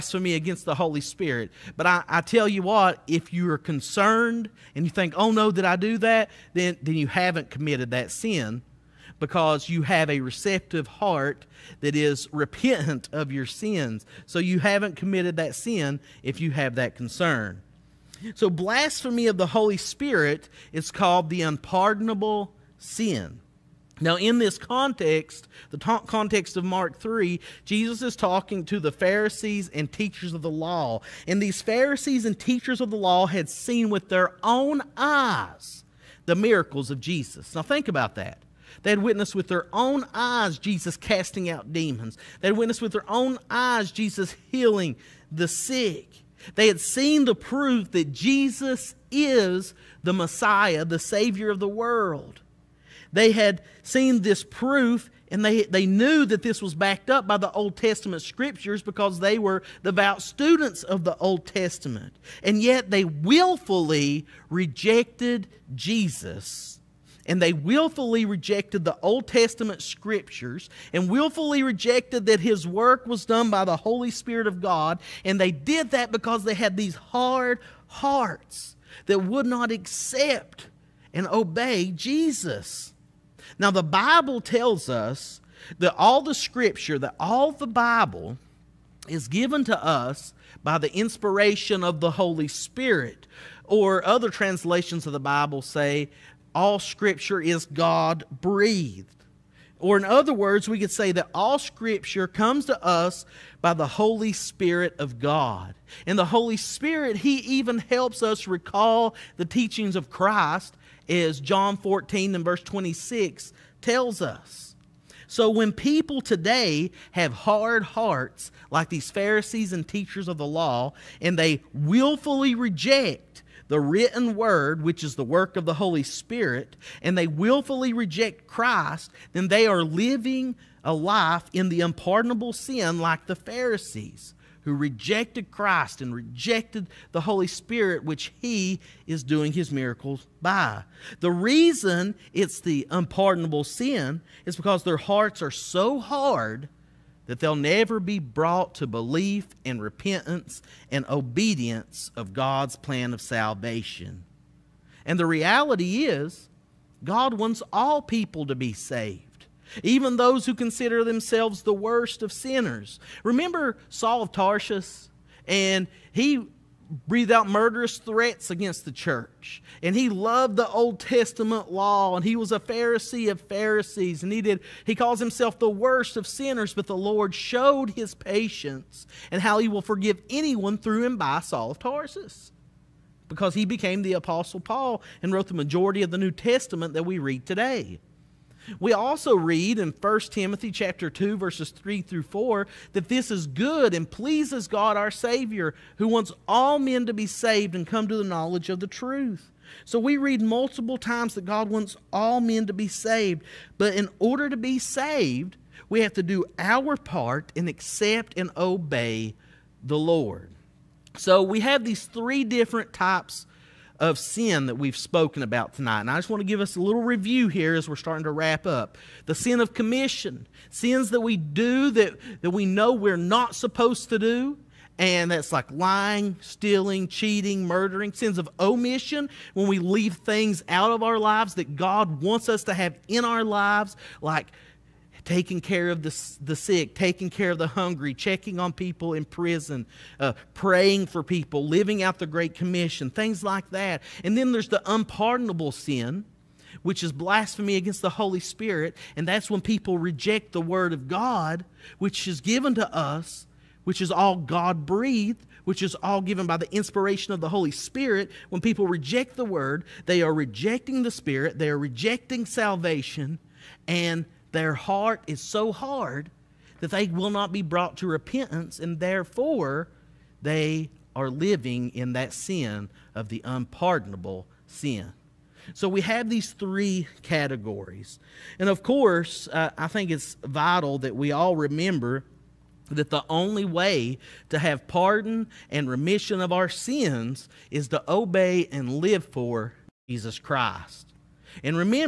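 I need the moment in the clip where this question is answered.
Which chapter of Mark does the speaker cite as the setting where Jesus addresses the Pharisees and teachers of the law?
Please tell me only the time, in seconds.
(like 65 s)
26 s.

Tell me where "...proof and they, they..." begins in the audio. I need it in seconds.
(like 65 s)
54 s.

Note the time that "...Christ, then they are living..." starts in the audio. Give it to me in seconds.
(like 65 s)
128 s.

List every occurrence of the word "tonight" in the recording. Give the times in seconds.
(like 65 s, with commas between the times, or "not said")
215 s.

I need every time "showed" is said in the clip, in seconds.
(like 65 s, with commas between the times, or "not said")
177 s.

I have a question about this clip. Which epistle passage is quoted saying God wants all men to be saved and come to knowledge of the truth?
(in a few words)
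1 Timothy 2:3-4.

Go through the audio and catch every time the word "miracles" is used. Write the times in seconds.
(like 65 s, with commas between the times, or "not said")
36 s, 139 s.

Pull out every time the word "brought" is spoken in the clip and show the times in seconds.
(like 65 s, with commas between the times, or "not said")
148 s, 267 s.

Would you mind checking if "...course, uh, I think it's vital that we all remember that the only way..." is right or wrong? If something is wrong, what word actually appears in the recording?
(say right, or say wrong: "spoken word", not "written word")
right.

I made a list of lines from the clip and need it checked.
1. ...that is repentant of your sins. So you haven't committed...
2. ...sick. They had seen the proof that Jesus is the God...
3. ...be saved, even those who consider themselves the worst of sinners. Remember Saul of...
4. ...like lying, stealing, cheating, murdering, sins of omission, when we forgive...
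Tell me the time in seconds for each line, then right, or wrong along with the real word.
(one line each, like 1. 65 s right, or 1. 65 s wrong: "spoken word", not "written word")
1. 11 s right
2. 45 s wrong: "Messiah", not "God"
3. 158 s right
4. 225 s wrong: "leave", not "forgive".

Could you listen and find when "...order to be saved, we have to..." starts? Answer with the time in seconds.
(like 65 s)
204 s.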